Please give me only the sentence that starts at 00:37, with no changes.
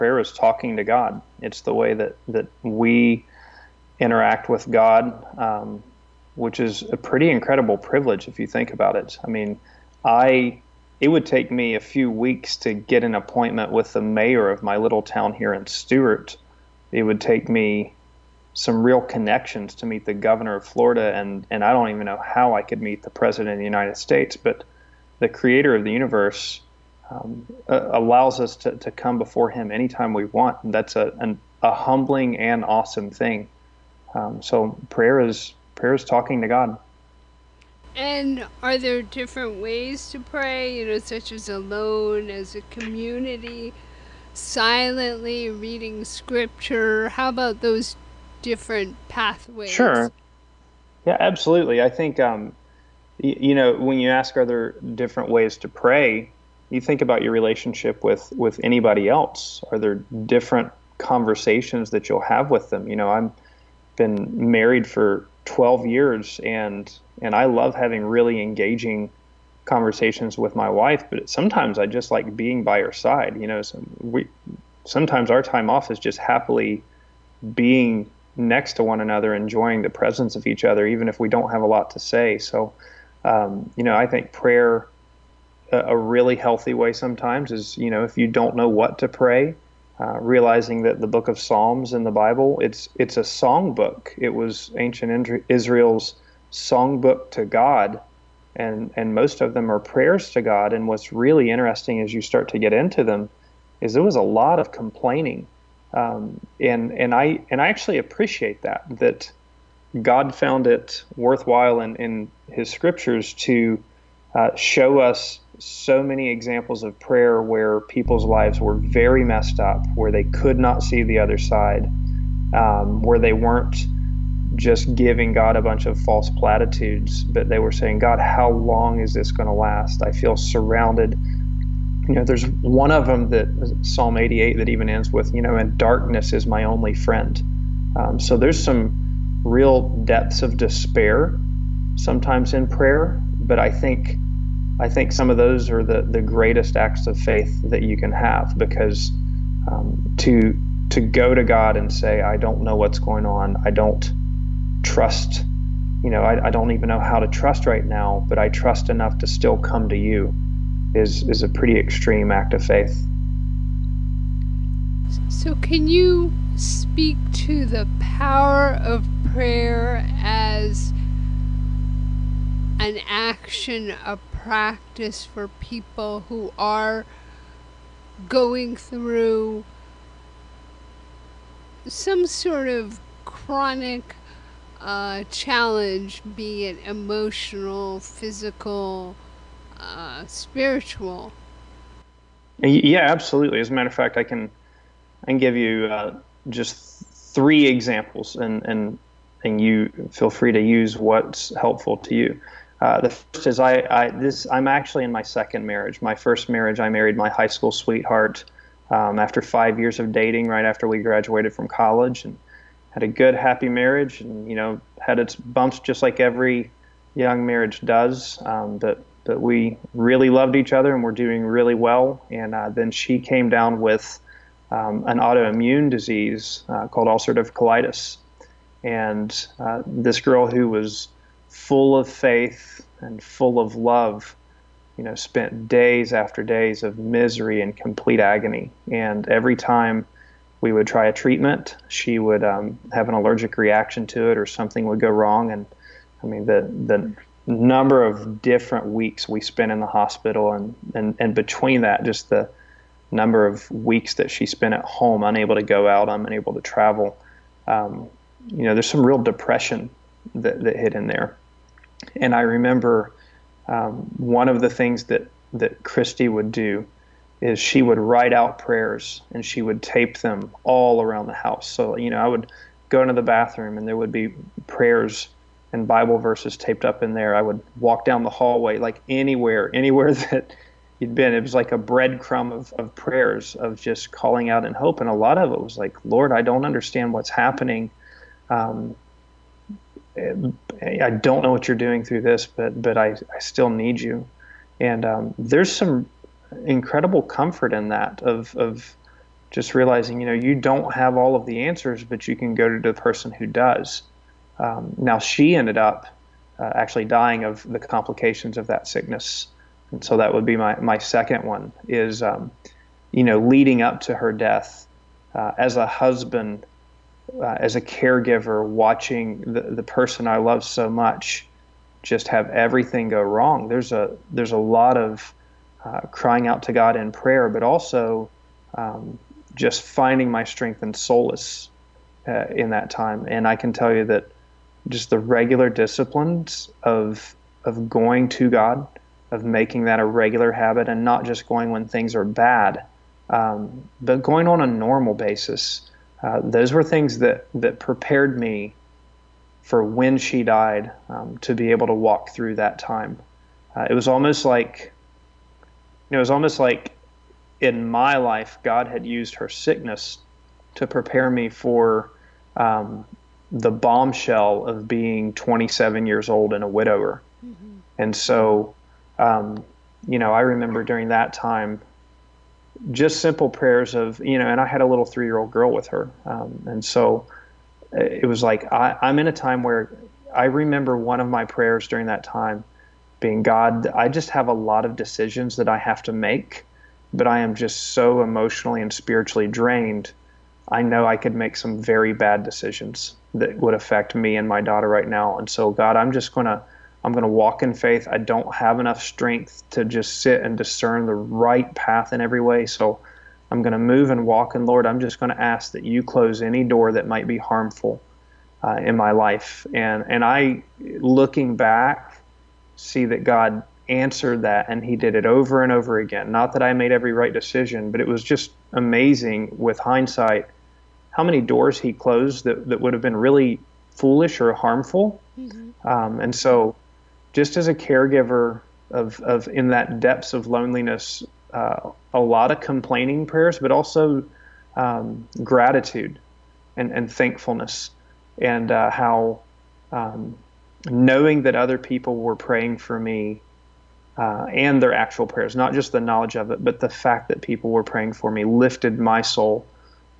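And are there different ways to pray?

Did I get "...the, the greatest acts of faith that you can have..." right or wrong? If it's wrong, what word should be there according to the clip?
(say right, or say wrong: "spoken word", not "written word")
right.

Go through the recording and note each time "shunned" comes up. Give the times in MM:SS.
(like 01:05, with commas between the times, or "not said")
not said.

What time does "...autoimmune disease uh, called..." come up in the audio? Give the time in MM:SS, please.
03:45.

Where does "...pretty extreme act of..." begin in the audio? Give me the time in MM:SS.
02:41.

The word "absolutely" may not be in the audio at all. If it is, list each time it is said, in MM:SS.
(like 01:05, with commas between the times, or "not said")
00:51, 03:13.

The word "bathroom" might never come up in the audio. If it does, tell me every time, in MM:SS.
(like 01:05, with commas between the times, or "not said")
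04:33.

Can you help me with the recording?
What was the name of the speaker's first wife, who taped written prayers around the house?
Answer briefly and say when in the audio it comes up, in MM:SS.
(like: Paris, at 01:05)
Christy, at 04:25.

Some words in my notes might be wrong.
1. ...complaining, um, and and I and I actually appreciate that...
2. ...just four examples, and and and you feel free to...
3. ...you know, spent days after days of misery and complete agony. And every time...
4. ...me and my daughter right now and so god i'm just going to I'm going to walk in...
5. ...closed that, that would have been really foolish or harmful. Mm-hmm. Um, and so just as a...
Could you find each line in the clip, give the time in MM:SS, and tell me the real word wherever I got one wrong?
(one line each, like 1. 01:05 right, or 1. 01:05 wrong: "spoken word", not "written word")
1. 01:44 right
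2. 03:16 wrong: "three", not "four"
3. 03:54 right
4. 06:34 right
5. 07:01 right.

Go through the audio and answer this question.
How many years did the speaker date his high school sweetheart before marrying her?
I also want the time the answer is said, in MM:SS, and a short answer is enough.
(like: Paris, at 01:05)
5, at 03:29.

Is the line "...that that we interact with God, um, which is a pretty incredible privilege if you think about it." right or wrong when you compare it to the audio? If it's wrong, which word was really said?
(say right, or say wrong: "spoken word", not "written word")
right.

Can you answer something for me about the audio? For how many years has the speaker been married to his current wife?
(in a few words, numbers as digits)
12.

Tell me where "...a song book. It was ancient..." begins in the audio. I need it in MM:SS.
01:33.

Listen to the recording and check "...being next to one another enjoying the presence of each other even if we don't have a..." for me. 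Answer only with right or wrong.
right.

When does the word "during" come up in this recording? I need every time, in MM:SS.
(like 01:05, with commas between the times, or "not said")
06:10, 06:21.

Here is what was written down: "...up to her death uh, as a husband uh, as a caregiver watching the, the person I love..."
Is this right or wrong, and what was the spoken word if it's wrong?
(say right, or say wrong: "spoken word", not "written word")
right.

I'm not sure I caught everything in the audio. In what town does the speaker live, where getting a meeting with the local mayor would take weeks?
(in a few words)
Stuart.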